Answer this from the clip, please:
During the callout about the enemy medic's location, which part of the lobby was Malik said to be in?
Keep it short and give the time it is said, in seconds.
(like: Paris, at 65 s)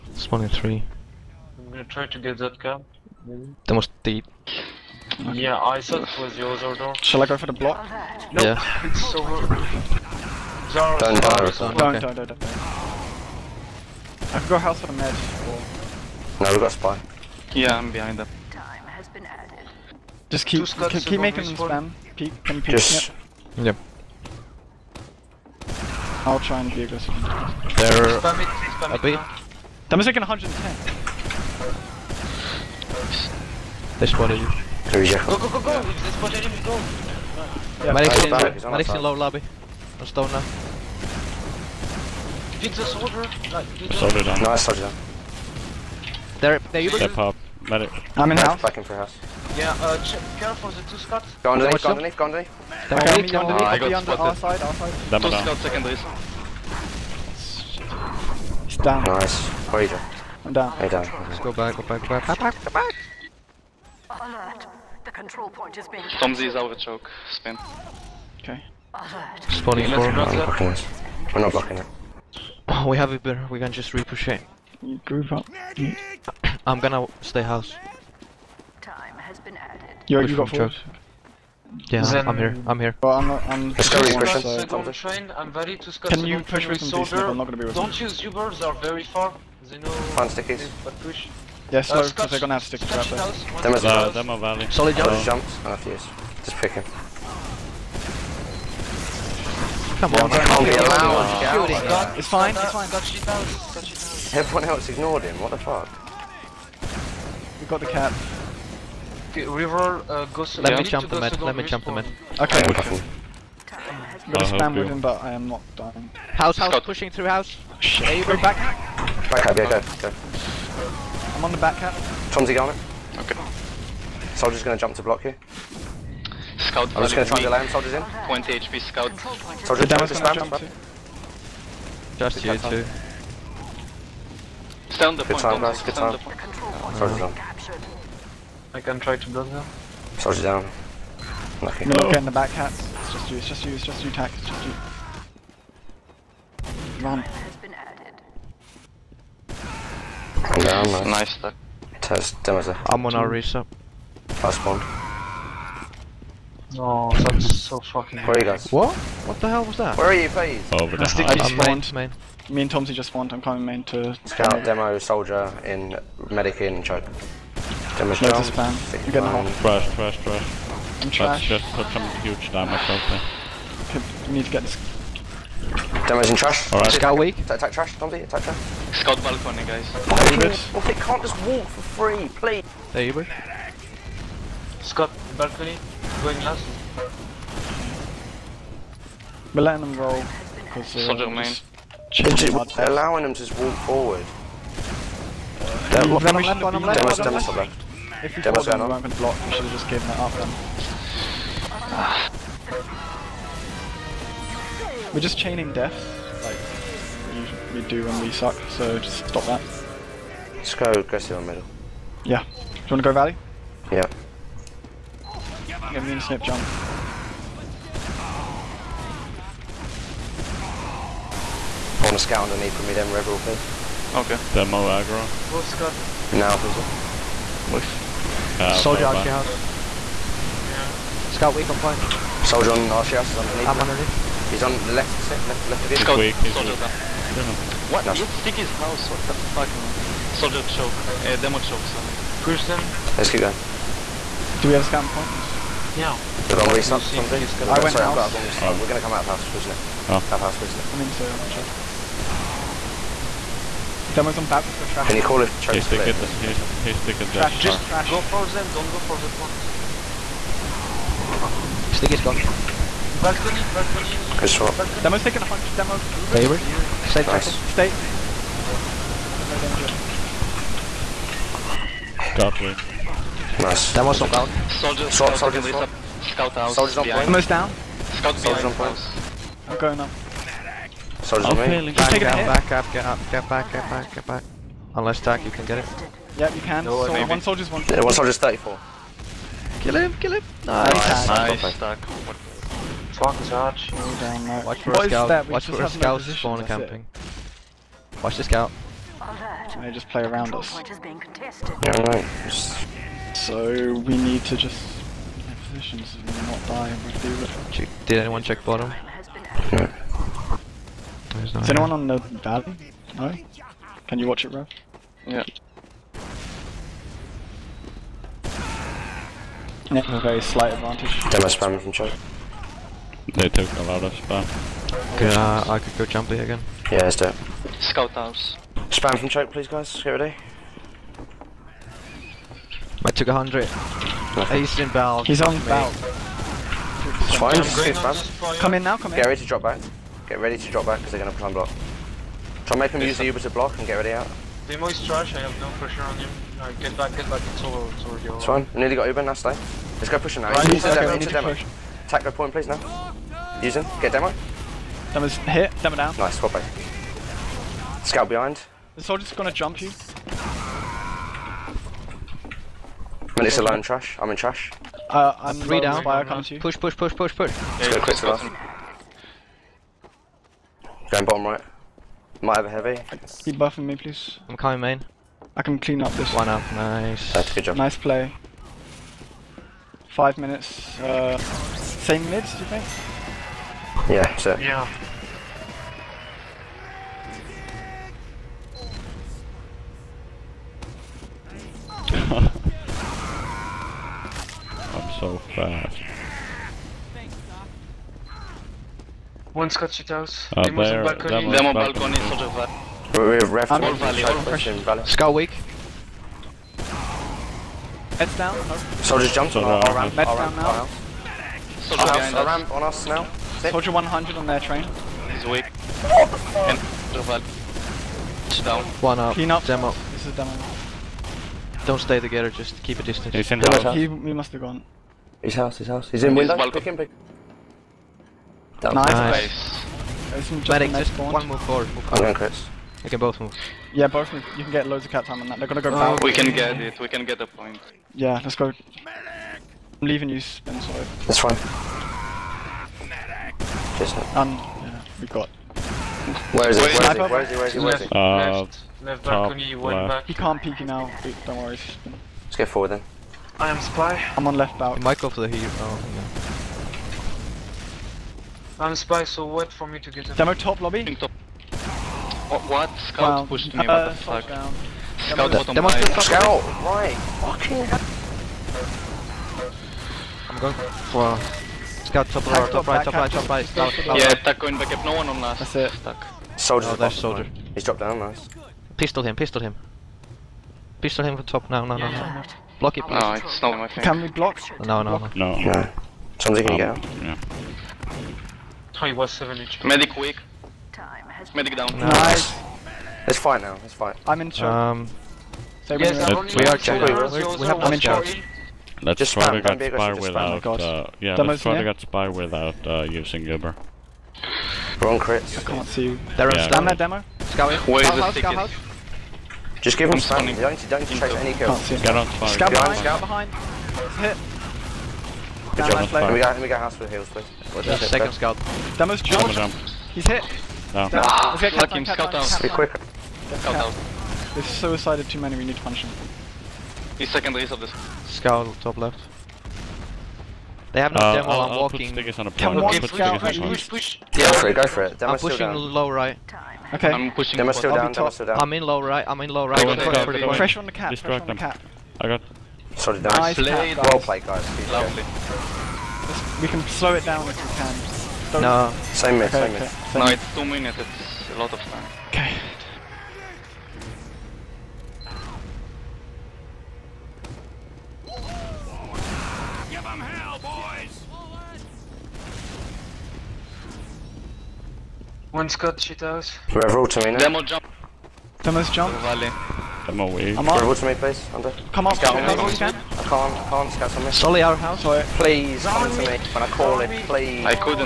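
low lobby, at 39 s.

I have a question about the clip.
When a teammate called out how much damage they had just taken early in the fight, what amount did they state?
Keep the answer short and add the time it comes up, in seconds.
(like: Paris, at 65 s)
110, at 30 s.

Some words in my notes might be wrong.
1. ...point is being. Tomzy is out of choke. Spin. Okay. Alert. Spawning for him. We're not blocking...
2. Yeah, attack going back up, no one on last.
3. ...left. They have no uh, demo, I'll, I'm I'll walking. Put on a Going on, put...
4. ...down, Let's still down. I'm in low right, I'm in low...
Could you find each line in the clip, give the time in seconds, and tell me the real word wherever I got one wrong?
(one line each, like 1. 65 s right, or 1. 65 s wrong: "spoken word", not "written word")
1. 65 s right
2. 474 s right
3. 528 s wrong: "Come", not "Going"
4. 537 s wrong: "Demo", not "Let".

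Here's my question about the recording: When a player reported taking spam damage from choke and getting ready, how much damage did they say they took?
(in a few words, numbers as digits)
100.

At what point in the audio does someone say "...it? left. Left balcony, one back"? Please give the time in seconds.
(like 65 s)
448 s.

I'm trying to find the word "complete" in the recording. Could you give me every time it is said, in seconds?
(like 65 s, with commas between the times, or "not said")
not said.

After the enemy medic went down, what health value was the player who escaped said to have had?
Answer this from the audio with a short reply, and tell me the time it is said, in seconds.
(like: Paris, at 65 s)
7 HP, at 489 s.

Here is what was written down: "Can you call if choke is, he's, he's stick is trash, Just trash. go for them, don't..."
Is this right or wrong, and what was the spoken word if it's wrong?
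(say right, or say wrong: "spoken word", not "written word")
right.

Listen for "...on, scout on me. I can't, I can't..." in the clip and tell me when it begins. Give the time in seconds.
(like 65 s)
572 s.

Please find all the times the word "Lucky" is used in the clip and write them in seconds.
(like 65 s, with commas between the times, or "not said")
141 s.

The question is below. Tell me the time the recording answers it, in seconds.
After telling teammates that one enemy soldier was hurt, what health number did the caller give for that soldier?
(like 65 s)
288 s.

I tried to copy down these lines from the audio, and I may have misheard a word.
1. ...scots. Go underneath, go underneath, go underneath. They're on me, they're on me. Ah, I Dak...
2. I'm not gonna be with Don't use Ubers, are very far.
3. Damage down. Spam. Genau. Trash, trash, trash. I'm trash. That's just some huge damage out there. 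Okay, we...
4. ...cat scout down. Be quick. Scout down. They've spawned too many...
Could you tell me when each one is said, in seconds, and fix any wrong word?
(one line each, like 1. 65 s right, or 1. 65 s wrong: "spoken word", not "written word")
1. 50 s wrong: "Our", not "Dak"
2. 87 s right
3. 168 s right
4. 521 s wrong: "suicided", not "spawned".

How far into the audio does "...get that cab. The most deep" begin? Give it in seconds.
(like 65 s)
2 s.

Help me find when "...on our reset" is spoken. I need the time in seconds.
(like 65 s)
153 s.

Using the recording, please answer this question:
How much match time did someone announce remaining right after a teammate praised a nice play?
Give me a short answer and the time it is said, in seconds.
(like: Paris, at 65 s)
5 minutes, at 380 s.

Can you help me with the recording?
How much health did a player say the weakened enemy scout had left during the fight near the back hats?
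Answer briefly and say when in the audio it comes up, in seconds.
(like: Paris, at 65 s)
20 HP, at 128 s.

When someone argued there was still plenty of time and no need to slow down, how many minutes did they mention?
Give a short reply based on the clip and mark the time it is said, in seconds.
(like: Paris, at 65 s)
2, at 550 s.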